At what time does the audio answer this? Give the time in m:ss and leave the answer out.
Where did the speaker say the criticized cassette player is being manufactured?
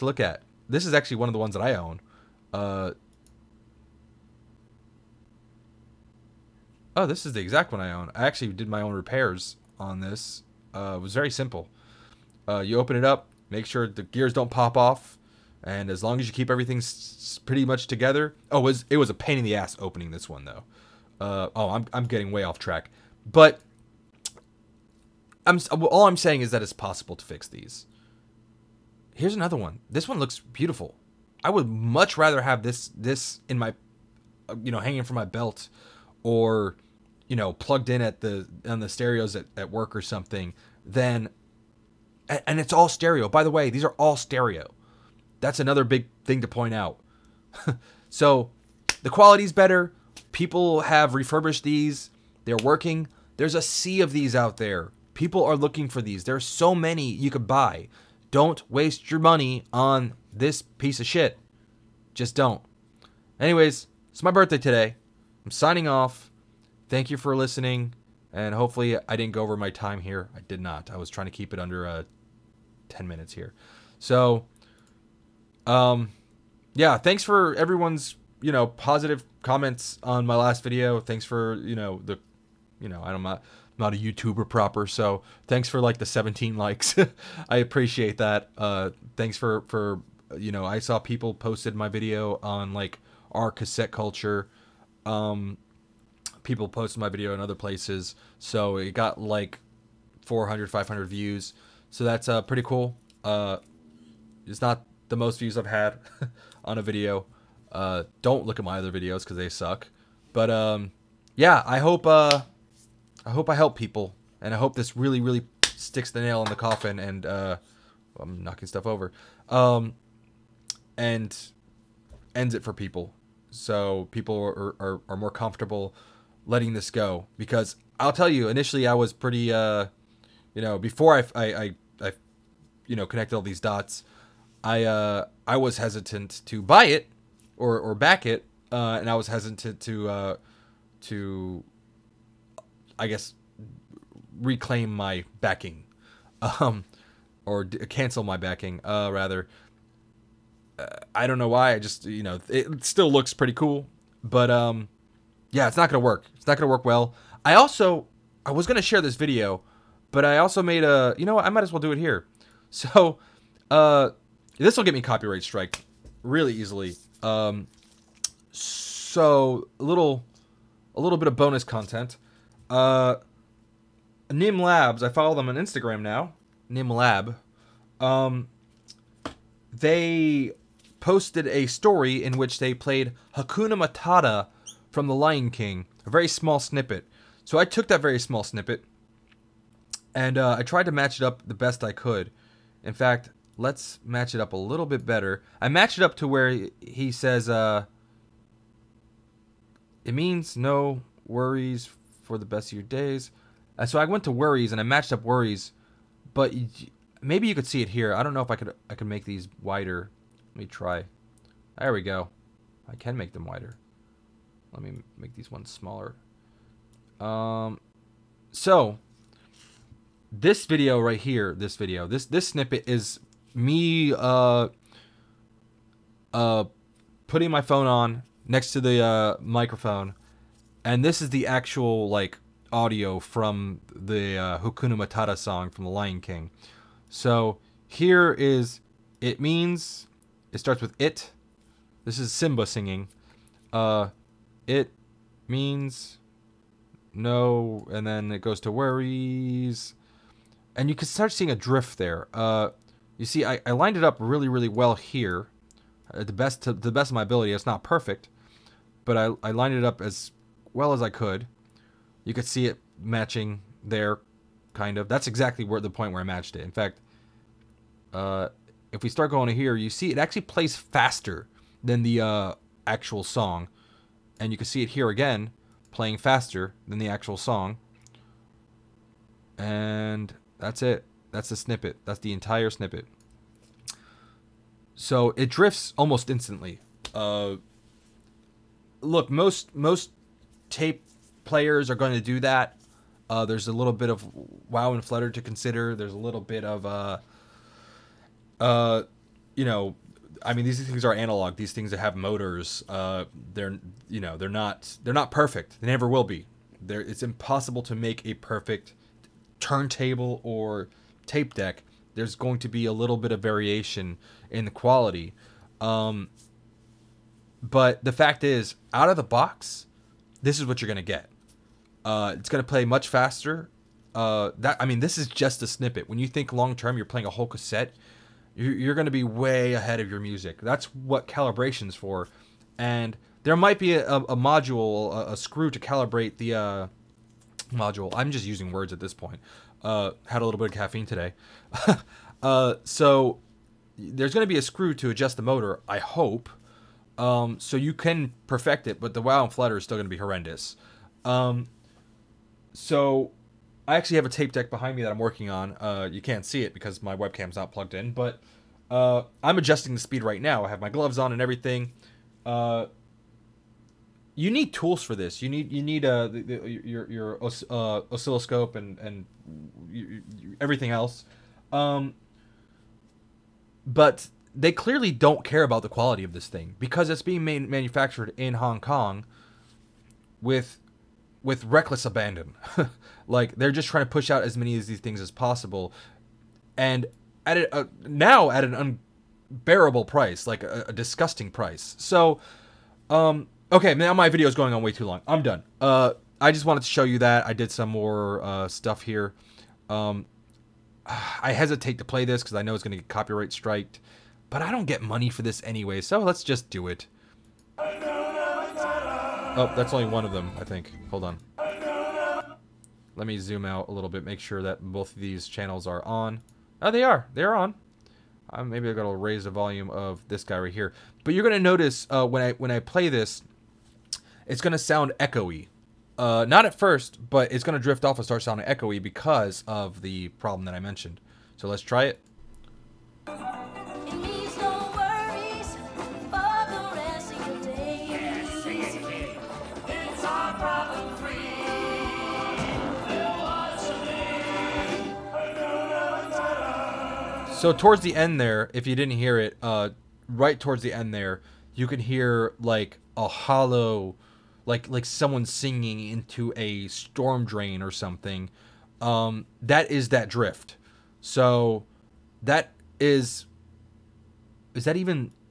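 6:18.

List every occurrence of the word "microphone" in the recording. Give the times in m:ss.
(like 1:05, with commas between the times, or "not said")
3:49.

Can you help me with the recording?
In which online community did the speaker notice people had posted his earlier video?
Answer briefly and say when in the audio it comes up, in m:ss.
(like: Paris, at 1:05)
Cassette Culture, at 1:33.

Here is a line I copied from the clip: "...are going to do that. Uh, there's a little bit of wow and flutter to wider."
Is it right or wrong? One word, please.
wrong.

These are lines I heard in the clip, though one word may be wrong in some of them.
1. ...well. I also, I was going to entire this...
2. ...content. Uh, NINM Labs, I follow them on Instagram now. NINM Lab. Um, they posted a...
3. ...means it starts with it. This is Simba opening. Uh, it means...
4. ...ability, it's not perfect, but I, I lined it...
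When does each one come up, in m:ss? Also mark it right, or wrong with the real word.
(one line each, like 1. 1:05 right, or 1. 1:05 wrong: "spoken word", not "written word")
1. 2:36 wrong: "share", not "entire"
2. 2:51 right
3. 3:59 wrong: "singing", not "opening"
4. 4:17 right.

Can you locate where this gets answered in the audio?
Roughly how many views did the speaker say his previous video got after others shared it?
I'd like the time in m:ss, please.
1:40.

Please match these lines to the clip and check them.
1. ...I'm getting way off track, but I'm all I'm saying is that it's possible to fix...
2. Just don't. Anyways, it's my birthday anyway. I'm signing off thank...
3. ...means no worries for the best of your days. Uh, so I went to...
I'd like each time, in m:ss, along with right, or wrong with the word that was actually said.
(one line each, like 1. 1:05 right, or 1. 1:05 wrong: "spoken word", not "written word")
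1. 0:21 right
2. 1:02 wrong: "today", not "anyway"
3. 3:20 right.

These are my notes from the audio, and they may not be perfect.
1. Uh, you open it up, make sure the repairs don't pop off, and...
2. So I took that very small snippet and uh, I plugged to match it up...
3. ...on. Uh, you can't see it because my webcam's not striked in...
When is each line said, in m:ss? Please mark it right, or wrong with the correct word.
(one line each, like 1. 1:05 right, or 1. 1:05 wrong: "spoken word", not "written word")
1. 0:12 wrong: "gears", not "repairs"
2. 3:07 wrong: "tried", not "plugged"
3. 5:55 wrong: "plugged", not "striked".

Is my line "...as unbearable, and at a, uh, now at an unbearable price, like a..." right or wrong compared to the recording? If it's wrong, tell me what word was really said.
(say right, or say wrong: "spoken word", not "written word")
wrong: "possible", not "unbearable".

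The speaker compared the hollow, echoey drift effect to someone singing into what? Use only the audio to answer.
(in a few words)
A storm drain.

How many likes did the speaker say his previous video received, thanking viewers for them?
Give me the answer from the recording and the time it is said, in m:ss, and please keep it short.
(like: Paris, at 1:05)
17, at 1:26.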